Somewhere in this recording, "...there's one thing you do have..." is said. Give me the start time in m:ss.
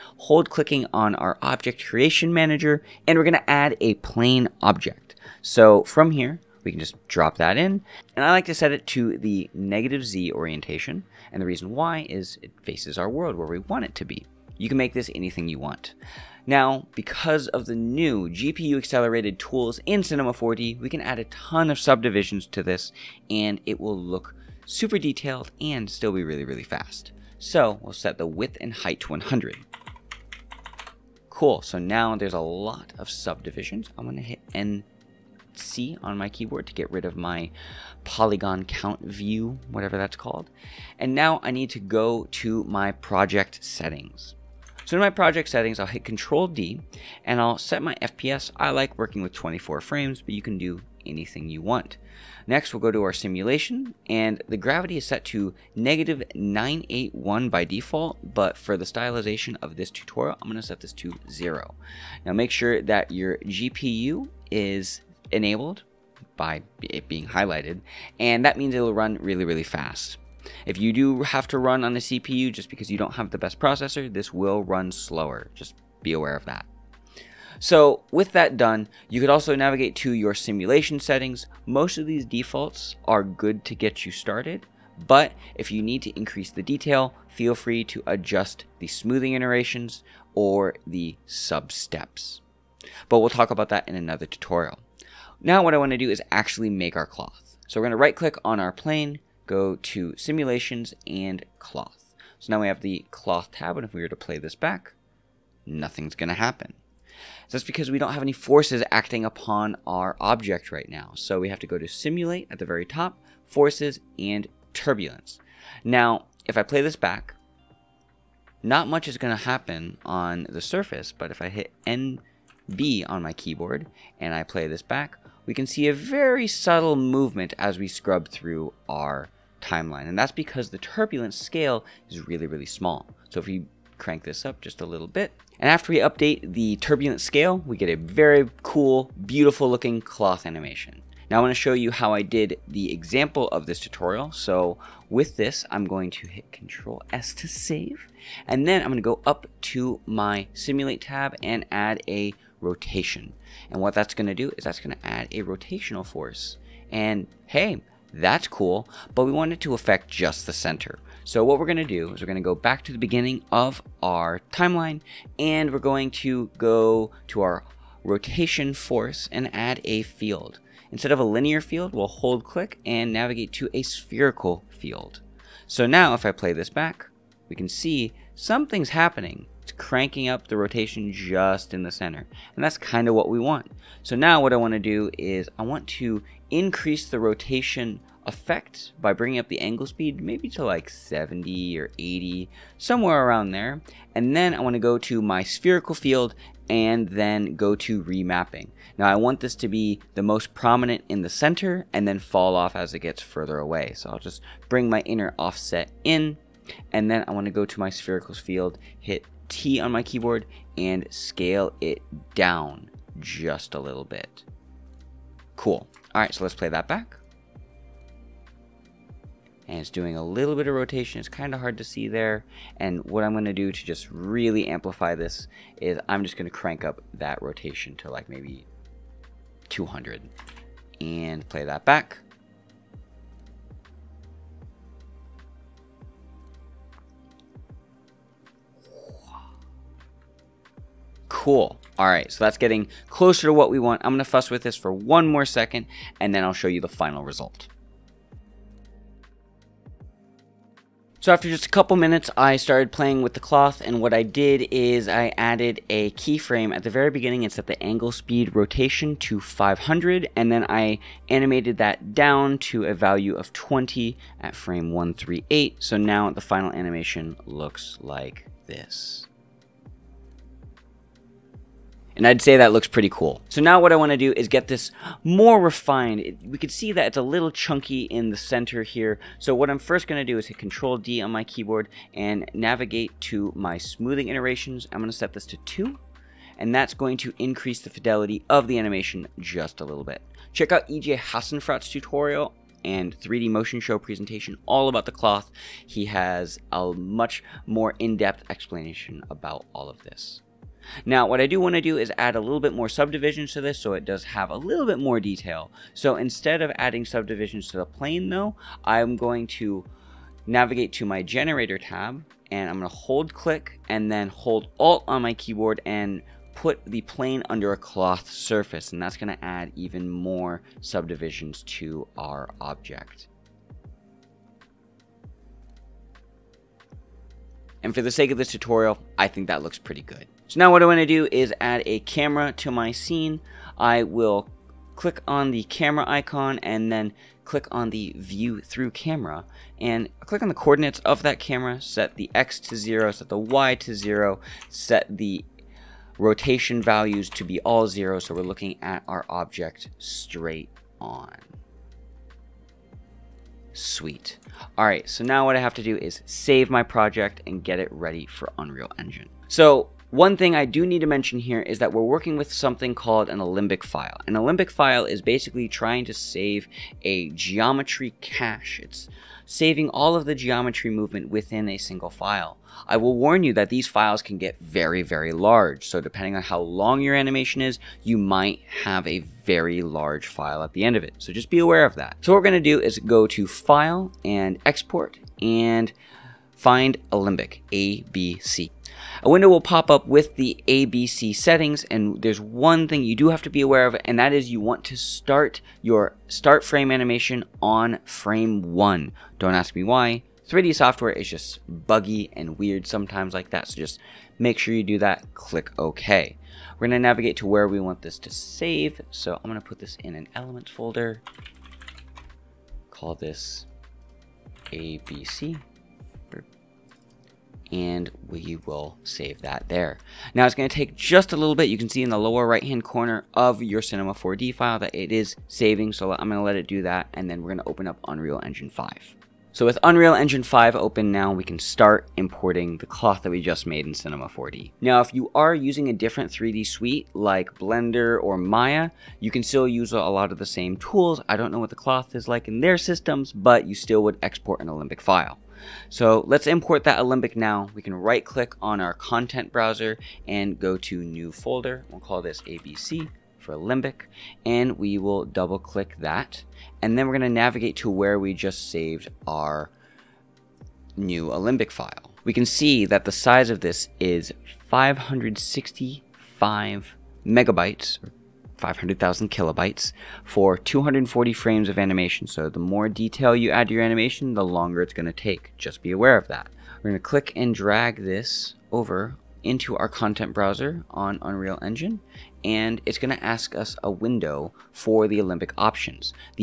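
6:32.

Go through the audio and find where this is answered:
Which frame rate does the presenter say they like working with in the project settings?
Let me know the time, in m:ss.
0:49.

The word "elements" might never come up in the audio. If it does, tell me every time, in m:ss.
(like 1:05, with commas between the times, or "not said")
6:50.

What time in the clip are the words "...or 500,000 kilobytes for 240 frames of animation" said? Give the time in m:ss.
7:48.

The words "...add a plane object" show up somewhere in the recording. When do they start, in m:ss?
0:03.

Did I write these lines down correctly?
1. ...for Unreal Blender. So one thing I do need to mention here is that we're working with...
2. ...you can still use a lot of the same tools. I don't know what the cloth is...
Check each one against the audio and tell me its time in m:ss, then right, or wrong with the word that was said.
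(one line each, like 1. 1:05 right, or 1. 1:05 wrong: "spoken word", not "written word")
1. 5:58 wrong: "Engine", not "Blender"
2. 7:19 right.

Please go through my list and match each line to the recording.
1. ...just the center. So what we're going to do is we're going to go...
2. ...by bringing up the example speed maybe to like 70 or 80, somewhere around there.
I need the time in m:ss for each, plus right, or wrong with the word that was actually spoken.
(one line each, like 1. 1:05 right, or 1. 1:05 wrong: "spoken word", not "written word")
1. 2:40 right
2. 3:09 wrong: "angle", not "example".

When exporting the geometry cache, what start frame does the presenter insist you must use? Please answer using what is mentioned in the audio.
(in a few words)
1.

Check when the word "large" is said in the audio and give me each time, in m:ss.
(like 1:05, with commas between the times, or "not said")
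6:15, 6:19.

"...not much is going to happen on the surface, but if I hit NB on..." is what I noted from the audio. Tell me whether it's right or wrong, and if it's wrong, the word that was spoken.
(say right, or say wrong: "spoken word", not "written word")
right.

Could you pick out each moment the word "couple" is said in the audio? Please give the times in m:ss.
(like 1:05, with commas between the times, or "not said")
4:11.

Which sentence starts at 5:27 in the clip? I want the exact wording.
And for the sake of this tutorial, I think that looks pretty good.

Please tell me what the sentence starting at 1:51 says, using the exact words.
So we have to go to simulate at the very top, forces and turbulence.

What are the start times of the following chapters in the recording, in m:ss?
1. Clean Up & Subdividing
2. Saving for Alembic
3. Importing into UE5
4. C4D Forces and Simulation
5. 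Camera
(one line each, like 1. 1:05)
1. 4:30
2. 5:54
3. 7:09
4. 1:42
5. 5:30.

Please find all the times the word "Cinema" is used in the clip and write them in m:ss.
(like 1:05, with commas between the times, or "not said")
0:20, 7:03, 7:13.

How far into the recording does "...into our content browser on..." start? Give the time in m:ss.
7:59.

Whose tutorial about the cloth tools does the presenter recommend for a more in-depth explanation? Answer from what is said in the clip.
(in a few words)
EJ Hassenfratz.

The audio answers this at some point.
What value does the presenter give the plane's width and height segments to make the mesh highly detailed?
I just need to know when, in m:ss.
0:29.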